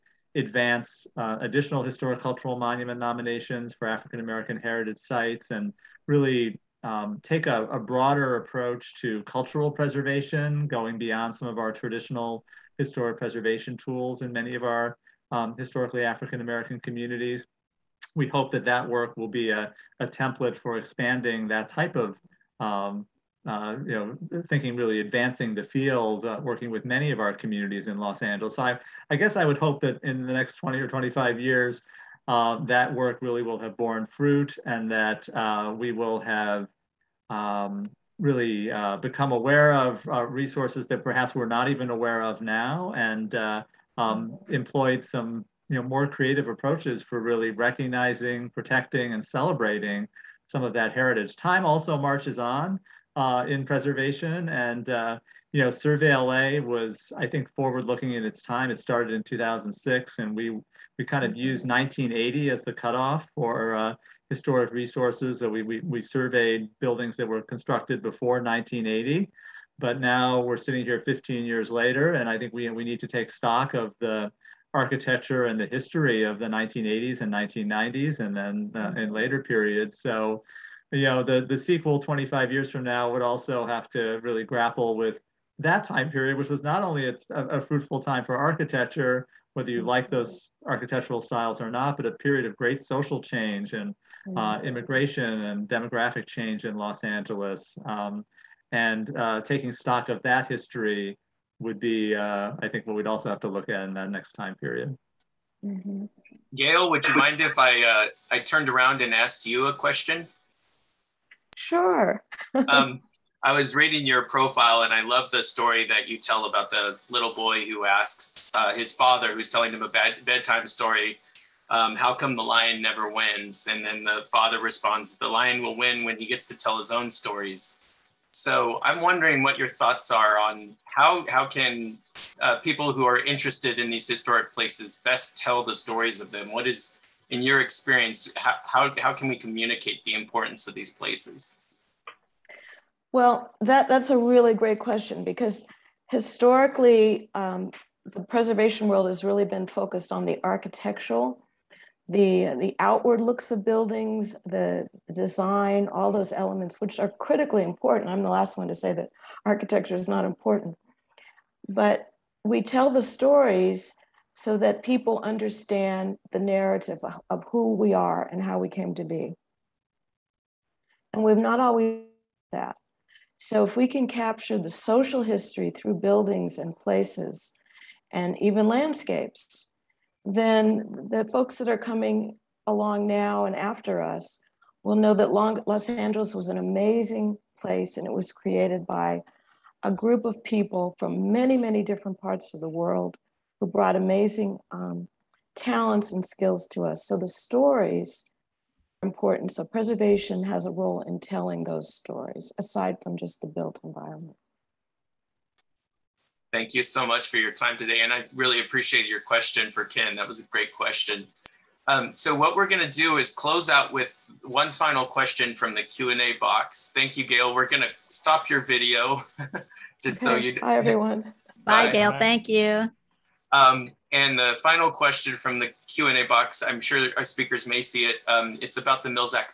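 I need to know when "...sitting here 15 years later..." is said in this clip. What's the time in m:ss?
1:10.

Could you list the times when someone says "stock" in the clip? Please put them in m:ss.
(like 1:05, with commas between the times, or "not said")
1:13, 1:39.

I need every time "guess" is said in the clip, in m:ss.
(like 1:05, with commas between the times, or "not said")
0:29.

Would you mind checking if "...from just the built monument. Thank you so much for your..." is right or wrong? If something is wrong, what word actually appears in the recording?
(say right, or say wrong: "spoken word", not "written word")
wrong: "environment", not "monument".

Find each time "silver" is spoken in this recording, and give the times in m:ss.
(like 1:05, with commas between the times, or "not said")
not said.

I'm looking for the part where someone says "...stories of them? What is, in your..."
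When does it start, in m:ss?
2:15.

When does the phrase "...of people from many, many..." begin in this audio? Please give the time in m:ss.
3:10.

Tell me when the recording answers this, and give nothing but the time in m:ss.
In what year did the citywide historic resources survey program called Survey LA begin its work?
0:59.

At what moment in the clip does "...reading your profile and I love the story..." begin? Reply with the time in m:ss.
1:53.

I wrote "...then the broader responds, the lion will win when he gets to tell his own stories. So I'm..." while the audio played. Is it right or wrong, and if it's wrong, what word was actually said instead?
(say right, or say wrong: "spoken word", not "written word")
wrong: "father", not "broader".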